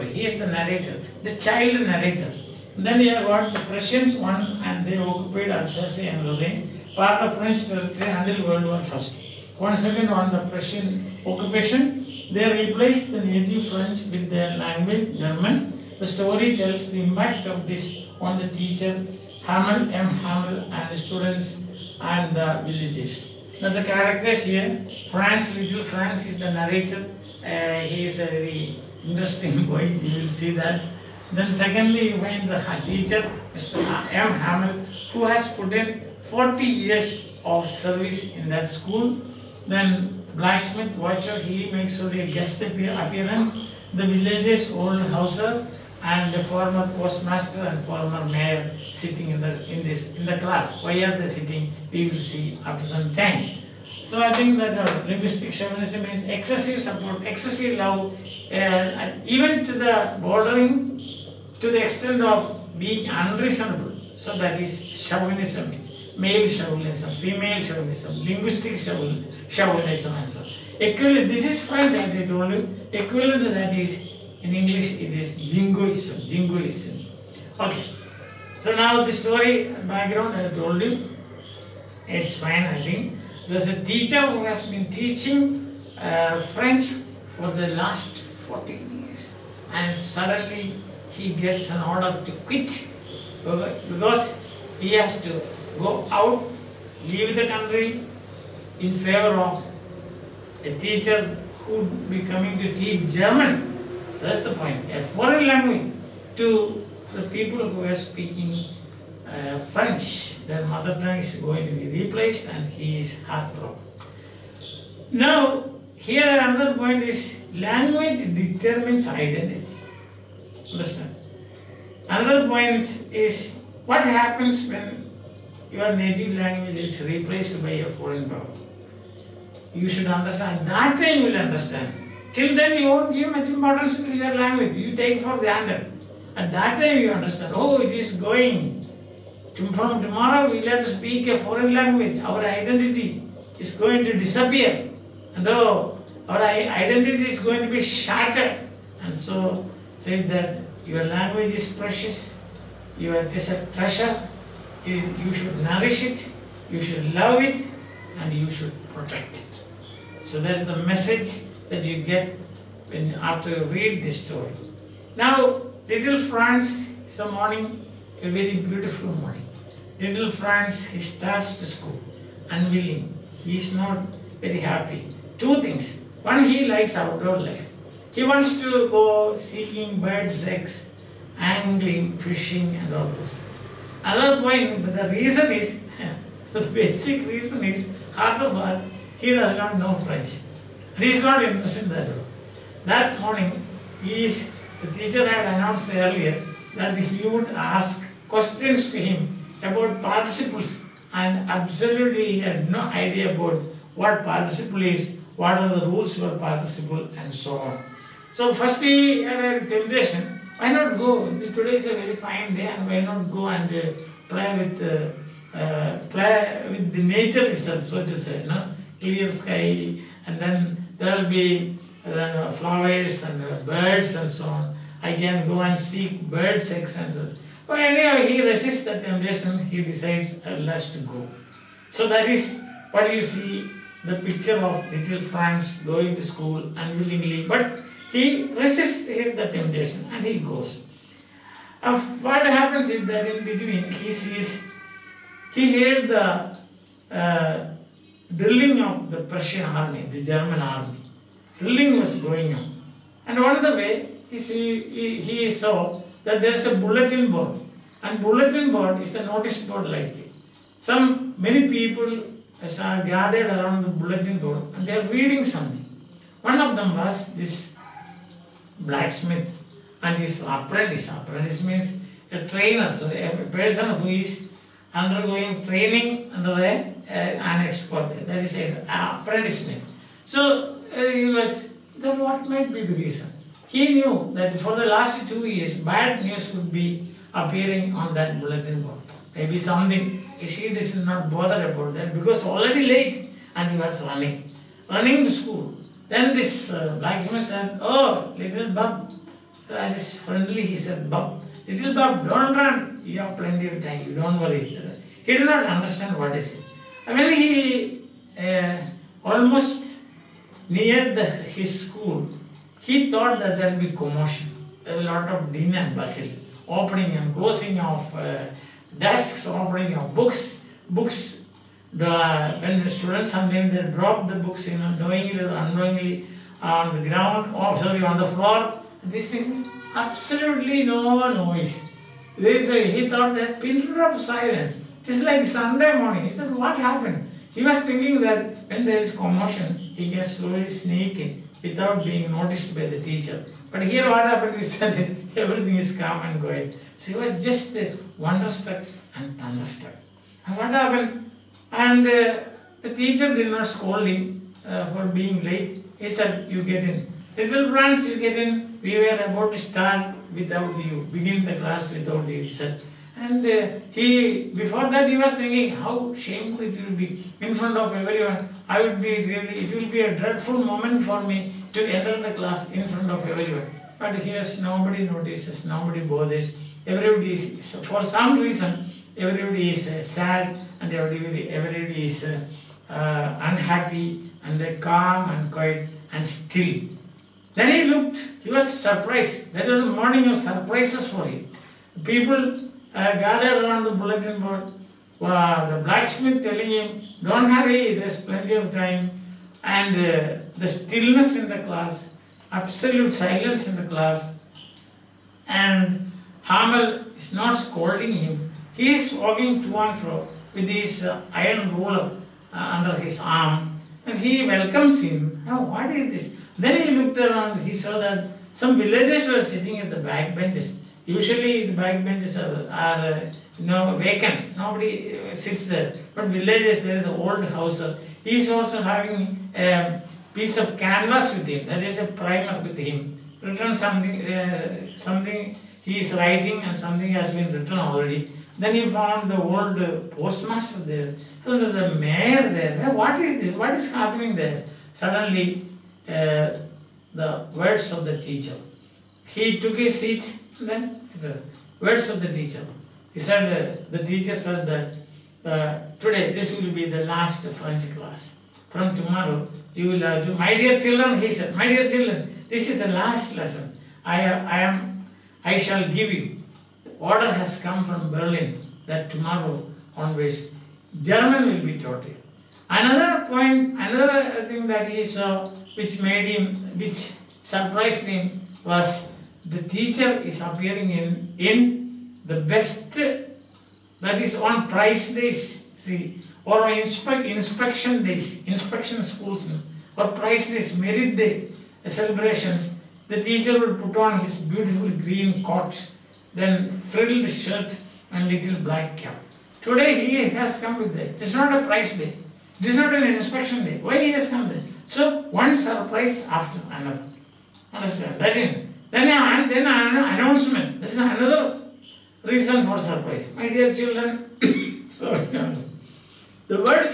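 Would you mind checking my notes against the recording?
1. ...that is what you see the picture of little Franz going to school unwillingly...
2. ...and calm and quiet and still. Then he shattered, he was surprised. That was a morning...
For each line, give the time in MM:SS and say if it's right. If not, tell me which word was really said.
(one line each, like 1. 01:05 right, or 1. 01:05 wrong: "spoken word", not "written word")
1. 03:52 right
2. 06:24 wrong: "looked", not "shattered".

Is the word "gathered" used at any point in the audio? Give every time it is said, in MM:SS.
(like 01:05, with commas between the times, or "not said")
04:23, 06:33.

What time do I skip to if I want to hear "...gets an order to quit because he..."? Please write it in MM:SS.
01:31.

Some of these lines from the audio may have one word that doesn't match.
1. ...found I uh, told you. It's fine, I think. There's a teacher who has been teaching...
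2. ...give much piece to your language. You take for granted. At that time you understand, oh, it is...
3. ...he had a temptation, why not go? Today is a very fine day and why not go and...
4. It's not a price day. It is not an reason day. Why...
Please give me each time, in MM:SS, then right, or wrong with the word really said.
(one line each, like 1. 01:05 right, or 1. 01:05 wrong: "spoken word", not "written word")
1. 01:19 wrong: "background", not "found"
2. 02:13 wrong: "importance", not "piece"
3. 03:28 right
4. 08:21 wrong: "inspection", not "reason".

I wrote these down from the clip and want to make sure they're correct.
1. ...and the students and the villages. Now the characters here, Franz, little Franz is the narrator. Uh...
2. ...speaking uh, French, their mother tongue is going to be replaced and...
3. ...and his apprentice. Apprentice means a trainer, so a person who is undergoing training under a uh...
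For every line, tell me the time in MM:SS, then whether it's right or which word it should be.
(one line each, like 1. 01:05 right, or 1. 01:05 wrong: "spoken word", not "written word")
1. 00:20 right
2. 01:47 right
3. 04:30 right.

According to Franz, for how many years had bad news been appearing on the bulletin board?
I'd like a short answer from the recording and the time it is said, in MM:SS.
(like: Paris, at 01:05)
2, at 04:45.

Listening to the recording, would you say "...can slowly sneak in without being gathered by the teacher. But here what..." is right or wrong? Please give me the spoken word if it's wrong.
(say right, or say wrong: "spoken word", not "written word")
wrong: "noticed", not "gathered".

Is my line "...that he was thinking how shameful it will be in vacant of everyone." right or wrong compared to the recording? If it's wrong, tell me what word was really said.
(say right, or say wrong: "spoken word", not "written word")
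wrong: "front", not "vacant".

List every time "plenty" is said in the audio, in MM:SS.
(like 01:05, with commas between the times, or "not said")
05:03, 06:38.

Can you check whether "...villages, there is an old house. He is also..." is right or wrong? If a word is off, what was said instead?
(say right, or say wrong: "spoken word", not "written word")
right.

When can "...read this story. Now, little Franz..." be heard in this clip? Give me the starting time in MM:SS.
02:43.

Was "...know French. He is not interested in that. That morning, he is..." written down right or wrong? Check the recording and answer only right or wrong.
right.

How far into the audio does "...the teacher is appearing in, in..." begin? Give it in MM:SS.
07:59.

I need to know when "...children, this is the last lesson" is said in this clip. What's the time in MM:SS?
07:41.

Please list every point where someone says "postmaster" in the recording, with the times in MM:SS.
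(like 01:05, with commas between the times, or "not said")
00:47, 07:20.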